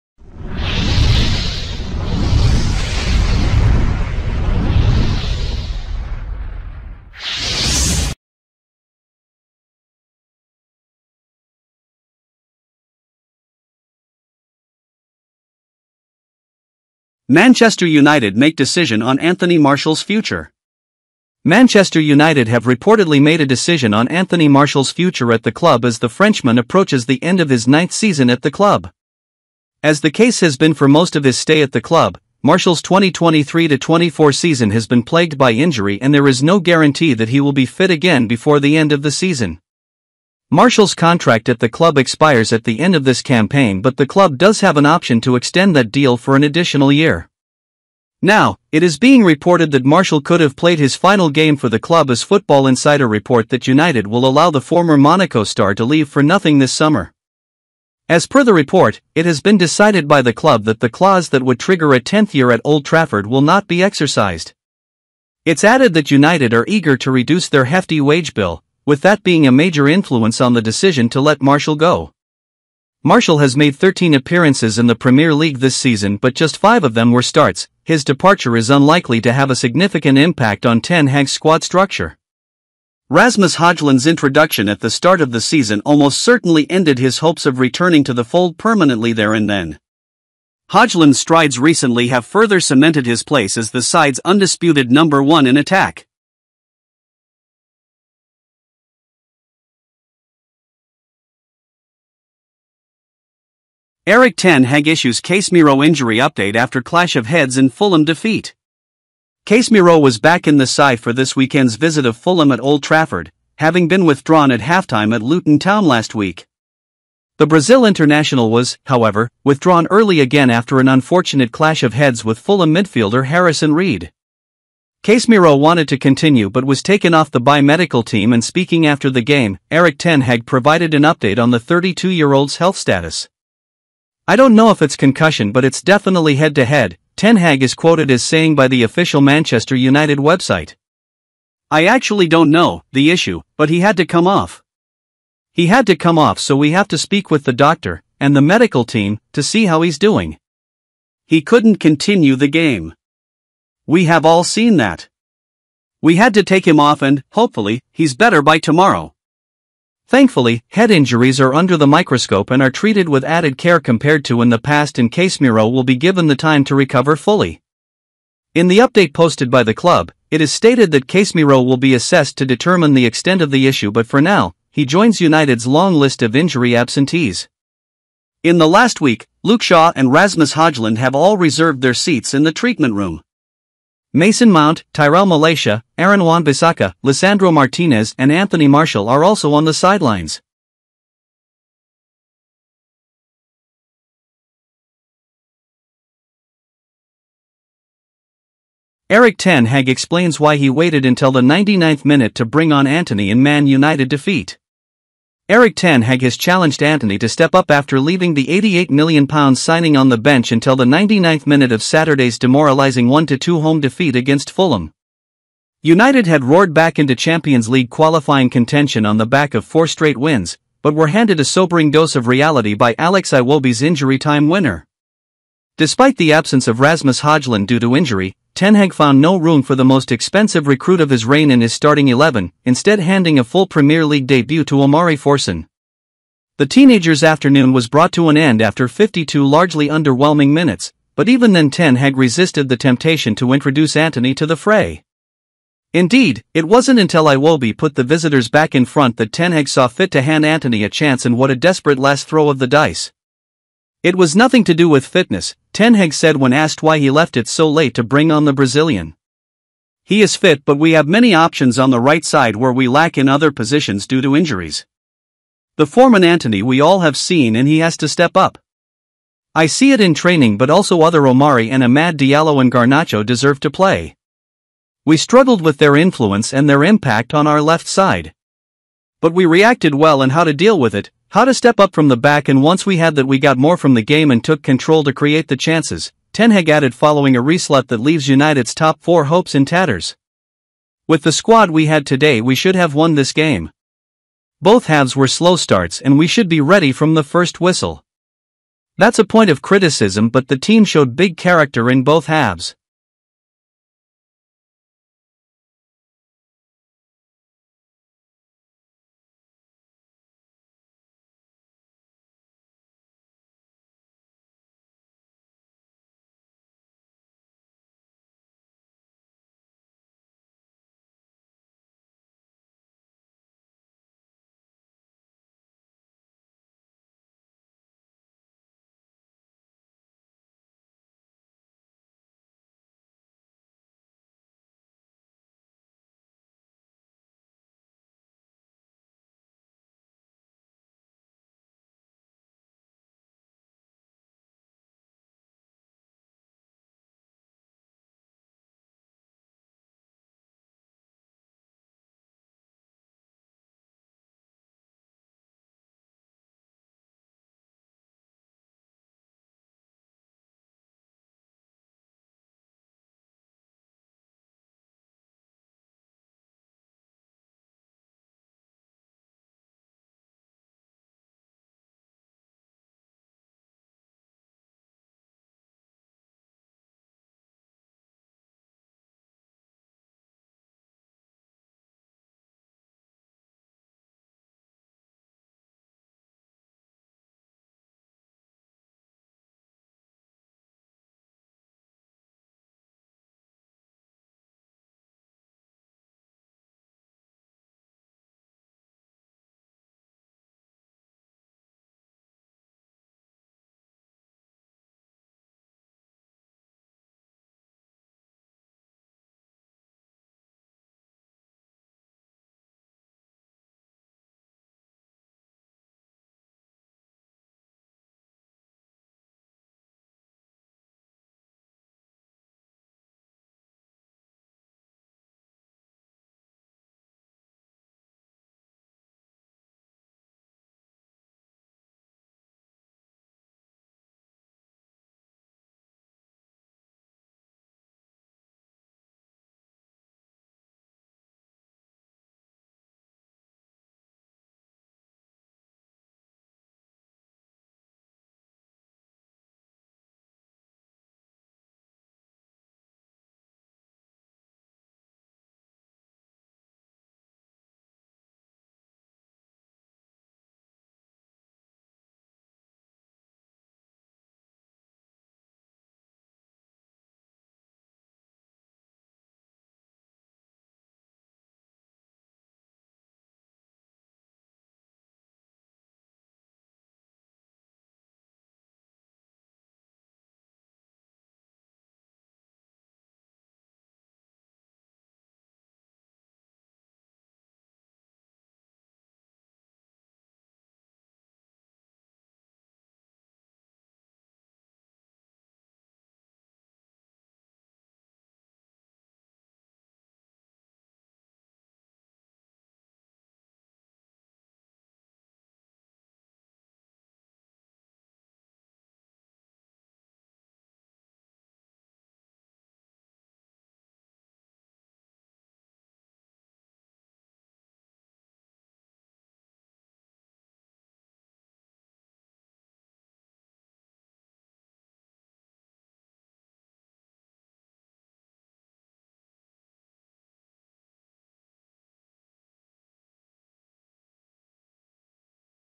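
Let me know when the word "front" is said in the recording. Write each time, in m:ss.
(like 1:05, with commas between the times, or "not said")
4:08.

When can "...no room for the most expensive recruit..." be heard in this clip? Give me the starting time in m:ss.
3:49.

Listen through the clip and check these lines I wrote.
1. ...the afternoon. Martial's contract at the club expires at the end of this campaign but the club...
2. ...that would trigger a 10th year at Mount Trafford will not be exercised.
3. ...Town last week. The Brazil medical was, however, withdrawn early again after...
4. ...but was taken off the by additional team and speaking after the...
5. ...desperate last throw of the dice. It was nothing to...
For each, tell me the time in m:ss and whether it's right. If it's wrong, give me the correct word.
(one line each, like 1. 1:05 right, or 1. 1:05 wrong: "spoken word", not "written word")
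1. 0:39 wrong: "season", not "afternoon"
2. 1:01 wrong: "Old", not "Mount"
3. 1:55 wrong: "international", not "medical"
4. 2:06 wrong: "medical", not "additional"
5. 4:11 right.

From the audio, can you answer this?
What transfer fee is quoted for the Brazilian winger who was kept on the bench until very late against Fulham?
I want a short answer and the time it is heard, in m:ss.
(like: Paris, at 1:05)
£88 million, at 3:28.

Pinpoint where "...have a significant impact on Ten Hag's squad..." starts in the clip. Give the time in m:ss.
1:19.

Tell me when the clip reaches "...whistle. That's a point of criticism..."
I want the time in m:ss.
4:57.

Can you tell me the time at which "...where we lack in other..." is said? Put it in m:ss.
4:22.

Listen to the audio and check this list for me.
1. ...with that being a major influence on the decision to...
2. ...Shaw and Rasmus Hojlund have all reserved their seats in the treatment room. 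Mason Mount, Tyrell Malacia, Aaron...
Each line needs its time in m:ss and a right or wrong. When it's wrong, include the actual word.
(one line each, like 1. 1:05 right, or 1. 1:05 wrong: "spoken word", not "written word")
1. 1:08 right
2. 2:59 right.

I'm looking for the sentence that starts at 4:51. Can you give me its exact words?
With the squad we had today we should have won this game.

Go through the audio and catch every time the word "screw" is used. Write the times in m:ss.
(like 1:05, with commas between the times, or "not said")
not said.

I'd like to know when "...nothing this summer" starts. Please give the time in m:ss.
0:56.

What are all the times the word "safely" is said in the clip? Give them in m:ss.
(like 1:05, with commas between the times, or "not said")
not said.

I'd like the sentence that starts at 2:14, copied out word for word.
I don't know if it's concussion but it's definitely head-to-head, -head.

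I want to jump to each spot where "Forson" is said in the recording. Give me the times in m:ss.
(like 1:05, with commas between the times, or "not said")
3:55.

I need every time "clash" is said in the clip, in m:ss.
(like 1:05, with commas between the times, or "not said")
1:46, 2:01.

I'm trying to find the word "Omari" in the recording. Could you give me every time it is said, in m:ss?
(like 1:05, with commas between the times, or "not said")
3:54, 4:31.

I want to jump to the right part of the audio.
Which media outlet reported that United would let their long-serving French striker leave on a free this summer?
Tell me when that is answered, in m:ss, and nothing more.
0:52.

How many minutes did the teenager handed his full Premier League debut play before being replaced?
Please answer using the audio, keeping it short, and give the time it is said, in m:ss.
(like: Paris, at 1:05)
52, at 3:58.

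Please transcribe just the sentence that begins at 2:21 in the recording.
I actually don't know, the issue, but he had to come off.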